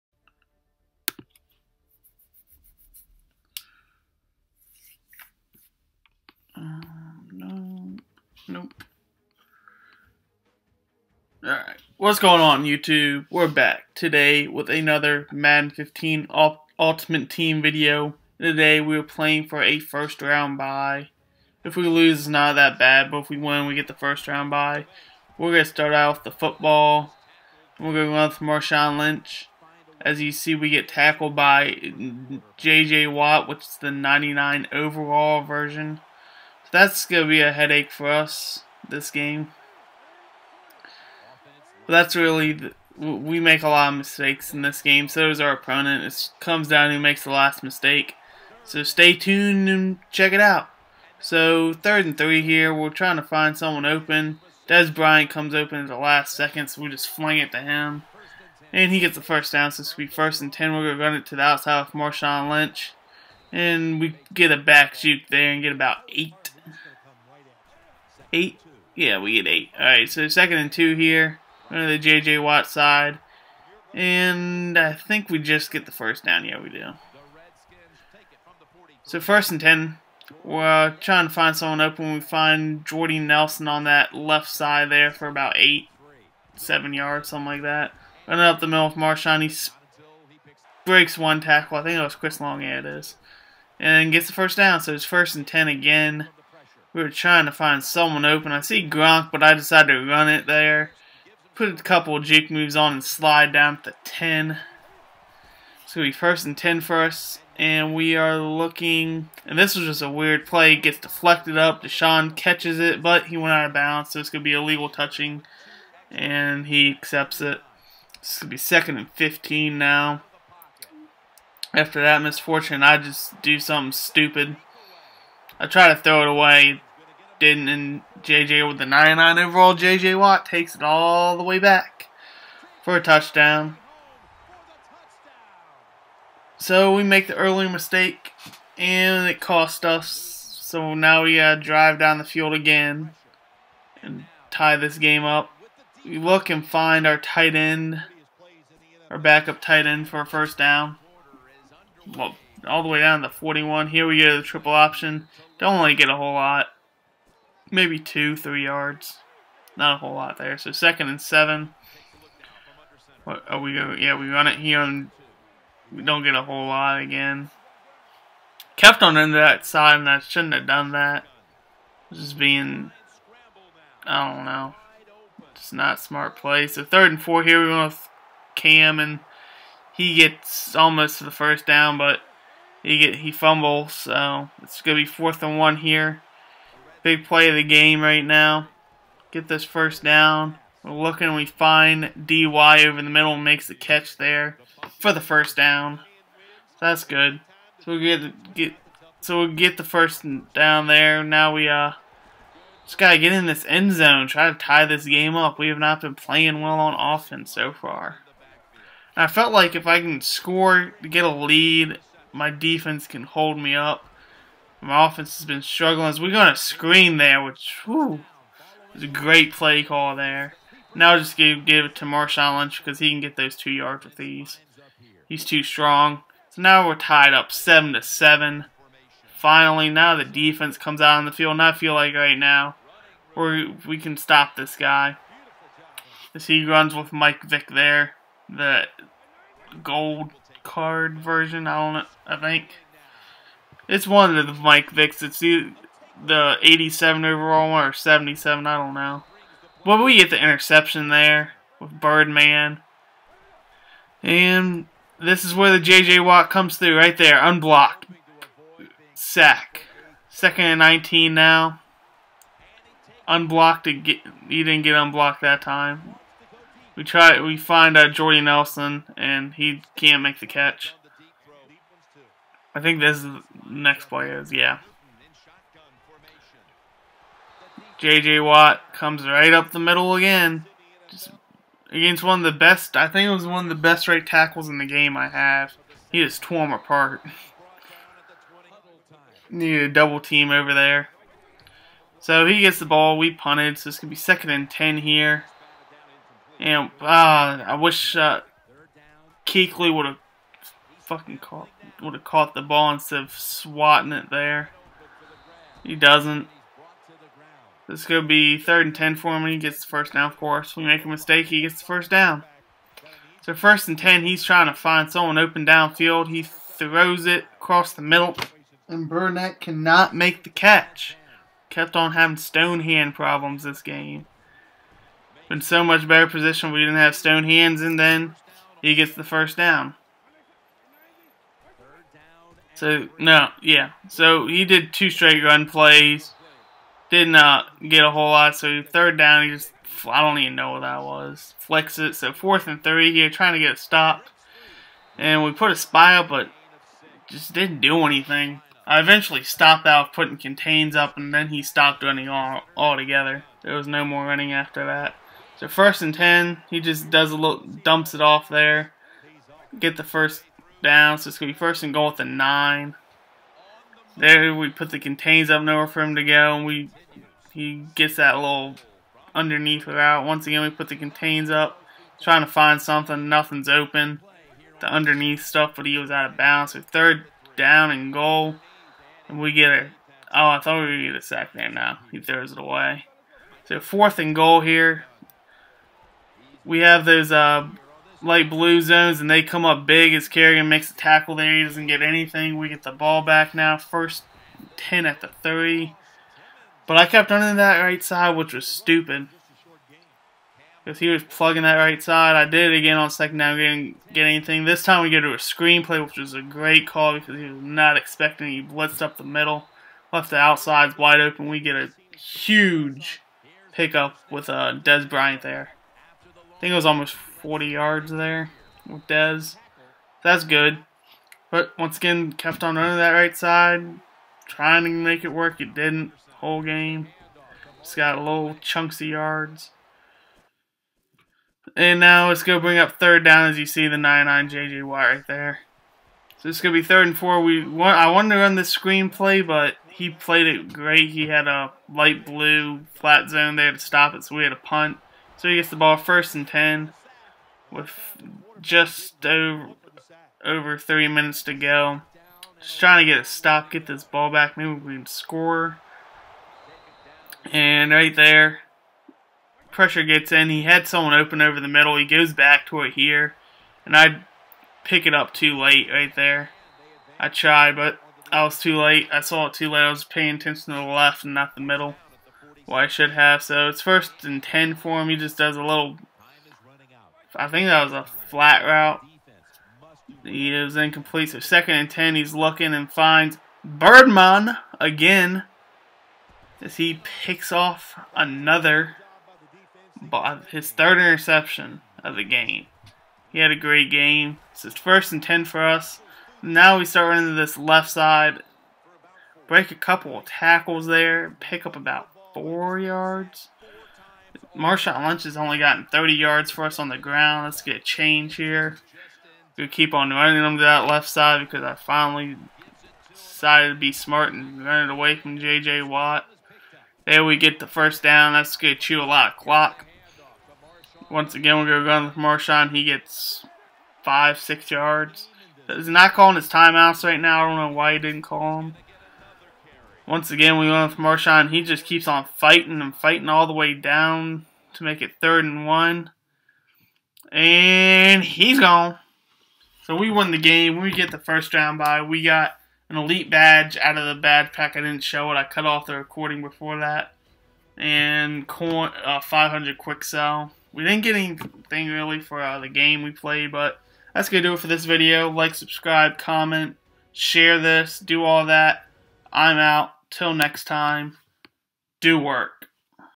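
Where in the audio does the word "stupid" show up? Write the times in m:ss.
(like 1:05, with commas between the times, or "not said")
2:03, 6:38.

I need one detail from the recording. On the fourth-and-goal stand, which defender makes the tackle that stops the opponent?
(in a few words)
Kerrigan.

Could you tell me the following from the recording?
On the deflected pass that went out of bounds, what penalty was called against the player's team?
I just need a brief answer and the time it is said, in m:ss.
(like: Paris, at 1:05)
illegal touching, at 1:54.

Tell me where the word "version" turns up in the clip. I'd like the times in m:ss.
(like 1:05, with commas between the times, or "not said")
0:35, 4:01.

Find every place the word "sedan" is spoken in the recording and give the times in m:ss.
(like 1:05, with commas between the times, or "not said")
not said.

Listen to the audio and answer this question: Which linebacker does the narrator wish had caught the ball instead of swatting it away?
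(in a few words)
Kuechly.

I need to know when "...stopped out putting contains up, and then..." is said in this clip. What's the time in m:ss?
5:49.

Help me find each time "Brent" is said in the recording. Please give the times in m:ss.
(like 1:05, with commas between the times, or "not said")
not said.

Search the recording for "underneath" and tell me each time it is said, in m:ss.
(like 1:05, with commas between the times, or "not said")
6:09, 6:14.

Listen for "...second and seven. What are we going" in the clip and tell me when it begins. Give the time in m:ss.
2:40.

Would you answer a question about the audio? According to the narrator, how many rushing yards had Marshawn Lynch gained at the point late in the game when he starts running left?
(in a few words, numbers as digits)
30 yards.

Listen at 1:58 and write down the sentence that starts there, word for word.
This going to be second and 15 now.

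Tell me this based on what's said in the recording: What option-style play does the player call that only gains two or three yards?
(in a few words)
triple option.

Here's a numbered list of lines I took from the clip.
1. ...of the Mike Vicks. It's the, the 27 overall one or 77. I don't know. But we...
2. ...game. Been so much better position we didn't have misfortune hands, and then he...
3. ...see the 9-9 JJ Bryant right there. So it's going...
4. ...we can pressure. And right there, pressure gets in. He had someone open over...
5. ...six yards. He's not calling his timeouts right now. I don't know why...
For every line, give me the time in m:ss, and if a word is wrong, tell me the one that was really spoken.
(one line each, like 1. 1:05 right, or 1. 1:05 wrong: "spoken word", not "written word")
1. 4:04 wrong: "87", not "27"
2. 5:23 wrong: "stone", not "misfortune"
3. 7:13 wrong: "Watt", not "Bryant"
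4. 7:34 wrong: "score", not "pressure"
5. 8:44 right.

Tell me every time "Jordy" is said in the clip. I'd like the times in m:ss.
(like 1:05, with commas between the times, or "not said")
1:22, 4:28.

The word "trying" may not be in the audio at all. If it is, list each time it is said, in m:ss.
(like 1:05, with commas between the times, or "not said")
0:52, 1:21, 1:37, 5:14, 5:43, 6:12, 7:04, 7:32.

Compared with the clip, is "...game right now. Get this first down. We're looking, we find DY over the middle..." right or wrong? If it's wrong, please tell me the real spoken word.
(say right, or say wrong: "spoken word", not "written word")
right.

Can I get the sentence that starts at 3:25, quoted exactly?
We have not been playing well on offense so far.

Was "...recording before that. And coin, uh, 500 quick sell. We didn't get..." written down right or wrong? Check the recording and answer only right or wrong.
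right.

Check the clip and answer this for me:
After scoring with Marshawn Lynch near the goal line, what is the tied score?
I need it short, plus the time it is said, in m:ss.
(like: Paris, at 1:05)
7 to 7, at 3:47.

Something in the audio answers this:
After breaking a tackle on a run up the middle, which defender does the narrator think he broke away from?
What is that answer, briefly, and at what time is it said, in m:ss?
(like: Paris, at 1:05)
Chris Long, at 1:32.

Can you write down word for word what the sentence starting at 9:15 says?
Like, subscribe, comment, share this, do all that.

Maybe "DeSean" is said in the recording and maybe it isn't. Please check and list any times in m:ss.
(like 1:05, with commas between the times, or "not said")
1:51.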